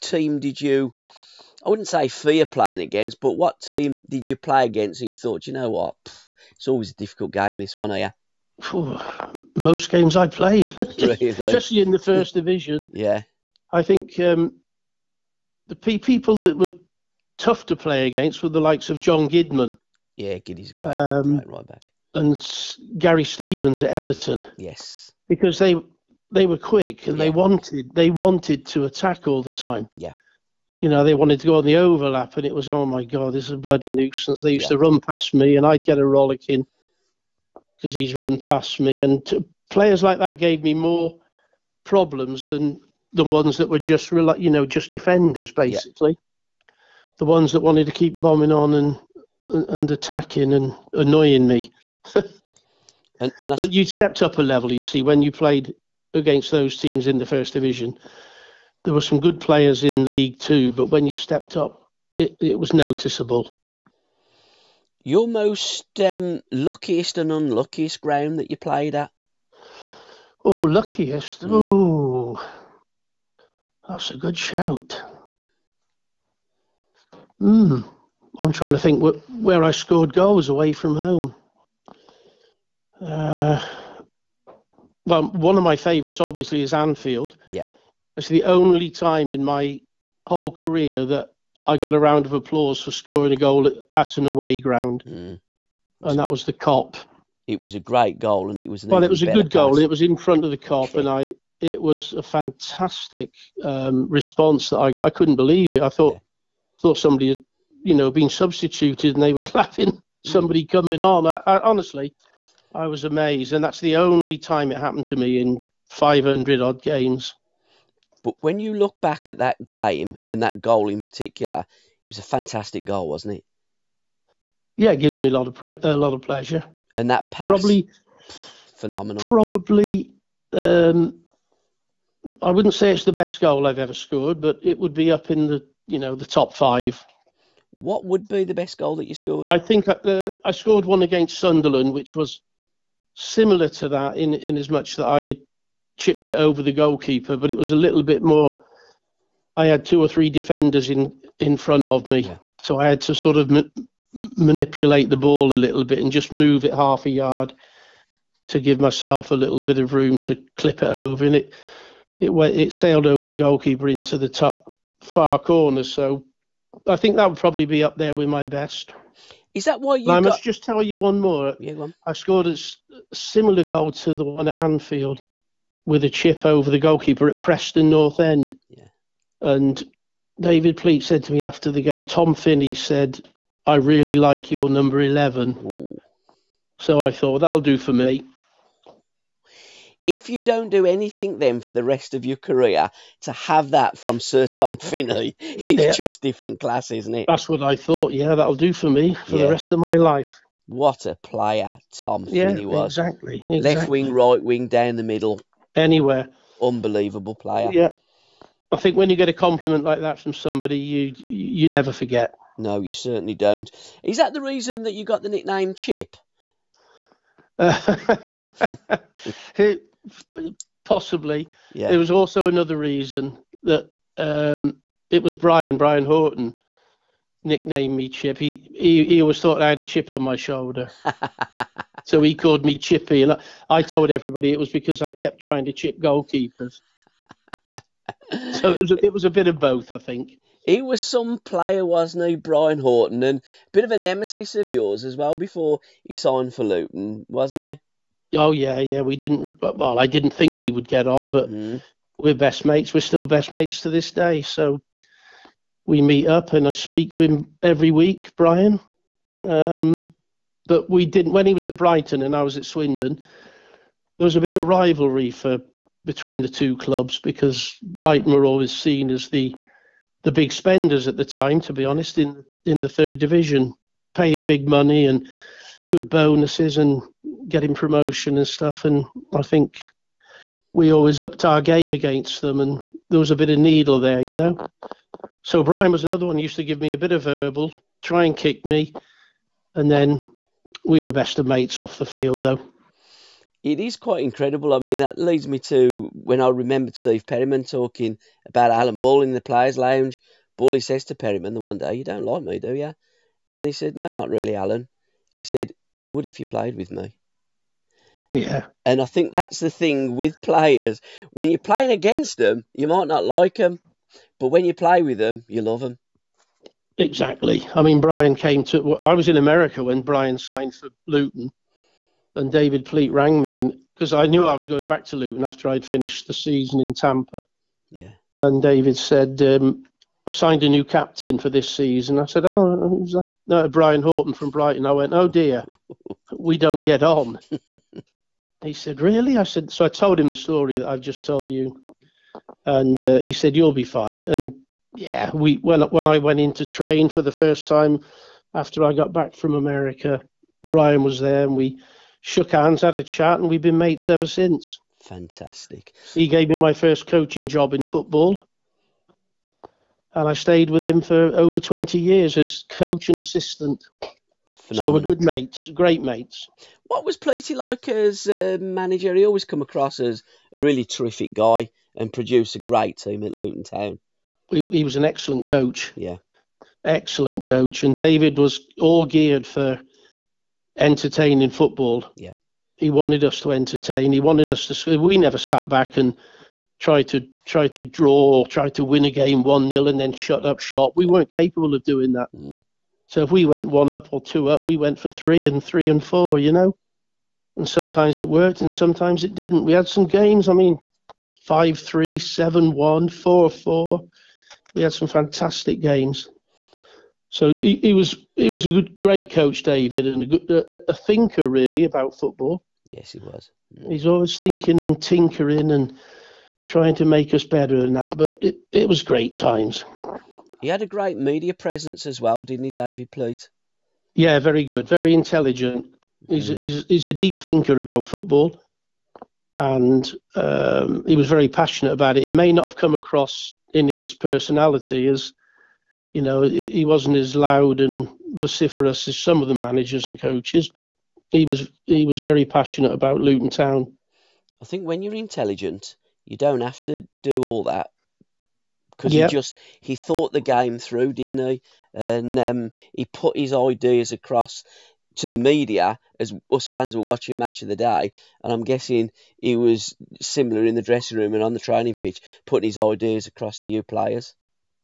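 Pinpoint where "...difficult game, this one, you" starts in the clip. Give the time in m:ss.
0:06.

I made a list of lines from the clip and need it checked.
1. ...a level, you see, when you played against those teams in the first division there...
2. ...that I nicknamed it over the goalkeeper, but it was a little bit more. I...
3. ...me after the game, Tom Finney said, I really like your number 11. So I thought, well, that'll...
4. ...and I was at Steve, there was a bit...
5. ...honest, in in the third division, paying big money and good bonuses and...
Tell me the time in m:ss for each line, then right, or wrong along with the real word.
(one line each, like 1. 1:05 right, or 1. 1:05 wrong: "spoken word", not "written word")
1. 0:54 right
2. 2:24 wrong: "chipped", not "nicknamed"
3. 3:01 right
4. 4:22 wrong: "Swindon", not "Steve"
5. 4:31 right.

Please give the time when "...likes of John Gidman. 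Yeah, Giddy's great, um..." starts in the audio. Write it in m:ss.
0:18.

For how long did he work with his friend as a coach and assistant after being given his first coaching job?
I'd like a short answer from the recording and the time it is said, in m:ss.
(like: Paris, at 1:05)
over 20 years, at 6:01.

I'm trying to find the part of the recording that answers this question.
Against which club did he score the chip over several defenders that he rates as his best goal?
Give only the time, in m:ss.
2:21.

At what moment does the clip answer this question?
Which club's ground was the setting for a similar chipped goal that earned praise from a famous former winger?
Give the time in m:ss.
2:57.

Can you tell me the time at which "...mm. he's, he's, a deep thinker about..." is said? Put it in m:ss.
7:06.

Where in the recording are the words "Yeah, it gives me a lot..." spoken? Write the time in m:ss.
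2:04.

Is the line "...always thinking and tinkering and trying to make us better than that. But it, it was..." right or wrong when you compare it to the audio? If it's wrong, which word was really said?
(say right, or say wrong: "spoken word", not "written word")
right.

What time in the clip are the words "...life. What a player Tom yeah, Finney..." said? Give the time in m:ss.
3:19.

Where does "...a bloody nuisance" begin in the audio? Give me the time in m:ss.
0:33.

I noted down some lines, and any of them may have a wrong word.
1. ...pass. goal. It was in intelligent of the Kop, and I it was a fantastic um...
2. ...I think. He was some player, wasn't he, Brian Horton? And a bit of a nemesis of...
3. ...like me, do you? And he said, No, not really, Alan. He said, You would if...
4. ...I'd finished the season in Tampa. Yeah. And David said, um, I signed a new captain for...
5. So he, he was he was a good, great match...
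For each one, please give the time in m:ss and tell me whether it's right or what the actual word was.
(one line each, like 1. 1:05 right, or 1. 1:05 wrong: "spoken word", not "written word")
1. 1:39 wrong: "front", not "intelligent"
2. 3:59 right
3. 5:02 right
4. 5:25 right
5. 6:47 wrong: "coach", not "match".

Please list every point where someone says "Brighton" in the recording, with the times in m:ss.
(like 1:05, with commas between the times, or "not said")
4:21, 4:27, 5:34.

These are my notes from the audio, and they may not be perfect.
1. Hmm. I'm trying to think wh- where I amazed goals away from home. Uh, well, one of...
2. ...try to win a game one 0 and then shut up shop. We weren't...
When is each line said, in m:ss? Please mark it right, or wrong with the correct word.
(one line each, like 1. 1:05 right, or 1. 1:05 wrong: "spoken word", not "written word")
1. 1:17 wrong: "scored", not "amazed"
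2. 6:28 right.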